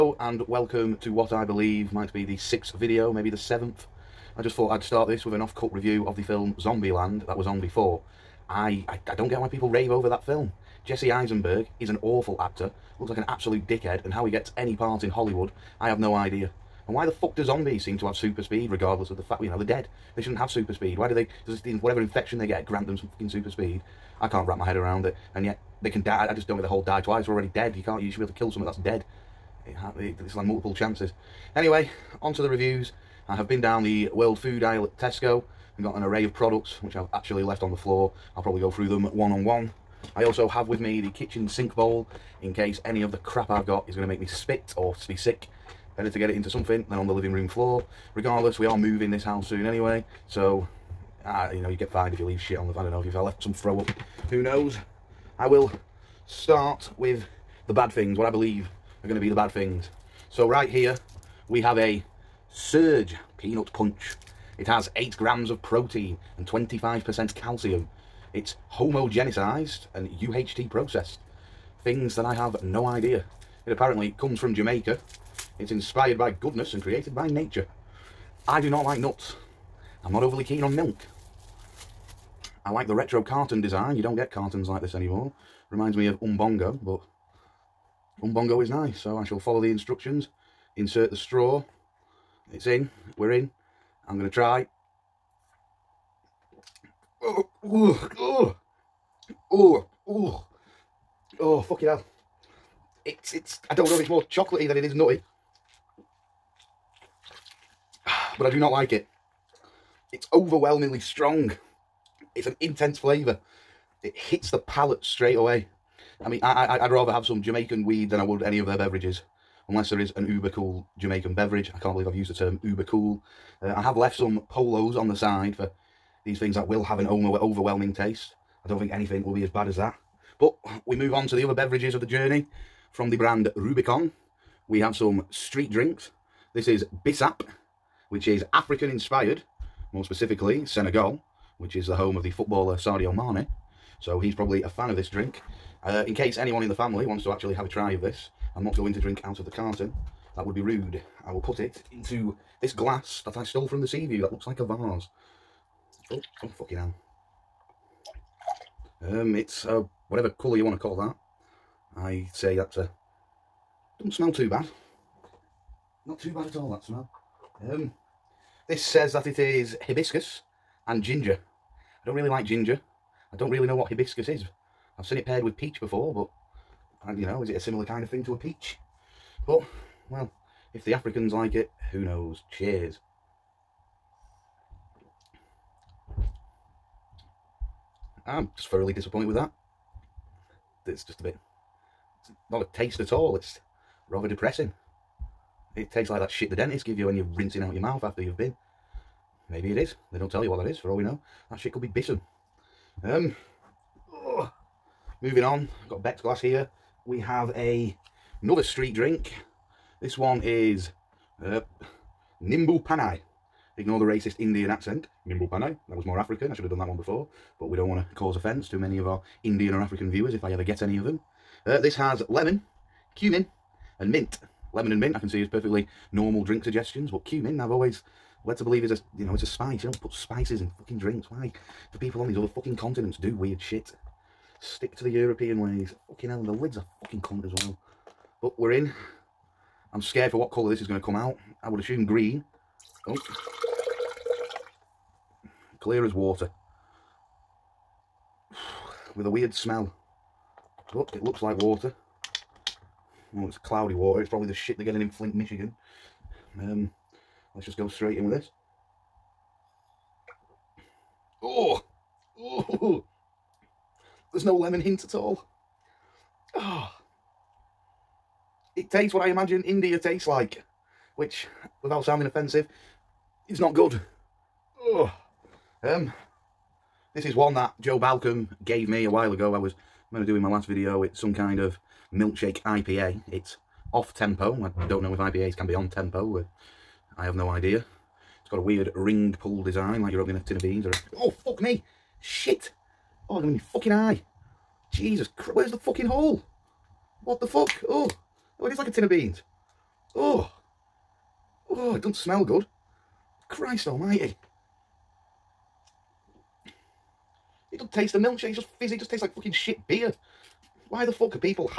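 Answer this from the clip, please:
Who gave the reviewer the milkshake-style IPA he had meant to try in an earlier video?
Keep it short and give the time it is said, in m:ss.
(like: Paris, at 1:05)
Joe Balcom, at 4:37.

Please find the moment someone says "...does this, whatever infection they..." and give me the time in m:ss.
0:21.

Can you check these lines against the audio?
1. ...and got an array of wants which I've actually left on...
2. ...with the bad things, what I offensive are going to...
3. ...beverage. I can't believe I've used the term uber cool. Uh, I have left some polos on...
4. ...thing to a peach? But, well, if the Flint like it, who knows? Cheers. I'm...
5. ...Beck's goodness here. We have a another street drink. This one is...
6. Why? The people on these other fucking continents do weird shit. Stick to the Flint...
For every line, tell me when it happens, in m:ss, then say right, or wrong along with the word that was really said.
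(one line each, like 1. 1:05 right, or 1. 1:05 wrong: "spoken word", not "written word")
1. 0:35 wrong: "products", not "wants"
2. 0:56 wrong: "believe", not "offensive"
3. 2:01 right
4. 2:58 wrong: "Africans", not "Flint"
5. 3:26 wrong: "glass", not "goodness"
6. 3:51 wrong: "European", not "Flint".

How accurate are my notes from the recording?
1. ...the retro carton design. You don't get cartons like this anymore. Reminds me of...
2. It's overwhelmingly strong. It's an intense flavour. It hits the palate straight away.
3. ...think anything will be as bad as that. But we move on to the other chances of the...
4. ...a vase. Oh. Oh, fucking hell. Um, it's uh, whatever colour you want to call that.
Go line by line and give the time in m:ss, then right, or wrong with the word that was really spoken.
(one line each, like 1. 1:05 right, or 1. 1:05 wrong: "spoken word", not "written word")
1. 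1:22 right
2. 1:50 right
3. 2:08 wrong: "beverages", not "chances"
4. 2:34 right.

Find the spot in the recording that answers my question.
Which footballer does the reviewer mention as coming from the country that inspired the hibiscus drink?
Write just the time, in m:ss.
2:22.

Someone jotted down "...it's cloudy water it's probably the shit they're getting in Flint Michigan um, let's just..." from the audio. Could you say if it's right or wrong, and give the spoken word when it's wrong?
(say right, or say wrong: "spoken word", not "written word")
right.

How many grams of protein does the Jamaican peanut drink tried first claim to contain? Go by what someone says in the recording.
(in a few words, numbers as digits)
8.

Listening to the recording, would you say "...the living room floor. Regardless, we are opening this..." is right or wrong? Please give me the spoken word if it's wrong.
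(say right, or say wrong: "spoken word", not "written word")
wrong: "moving", not "opening".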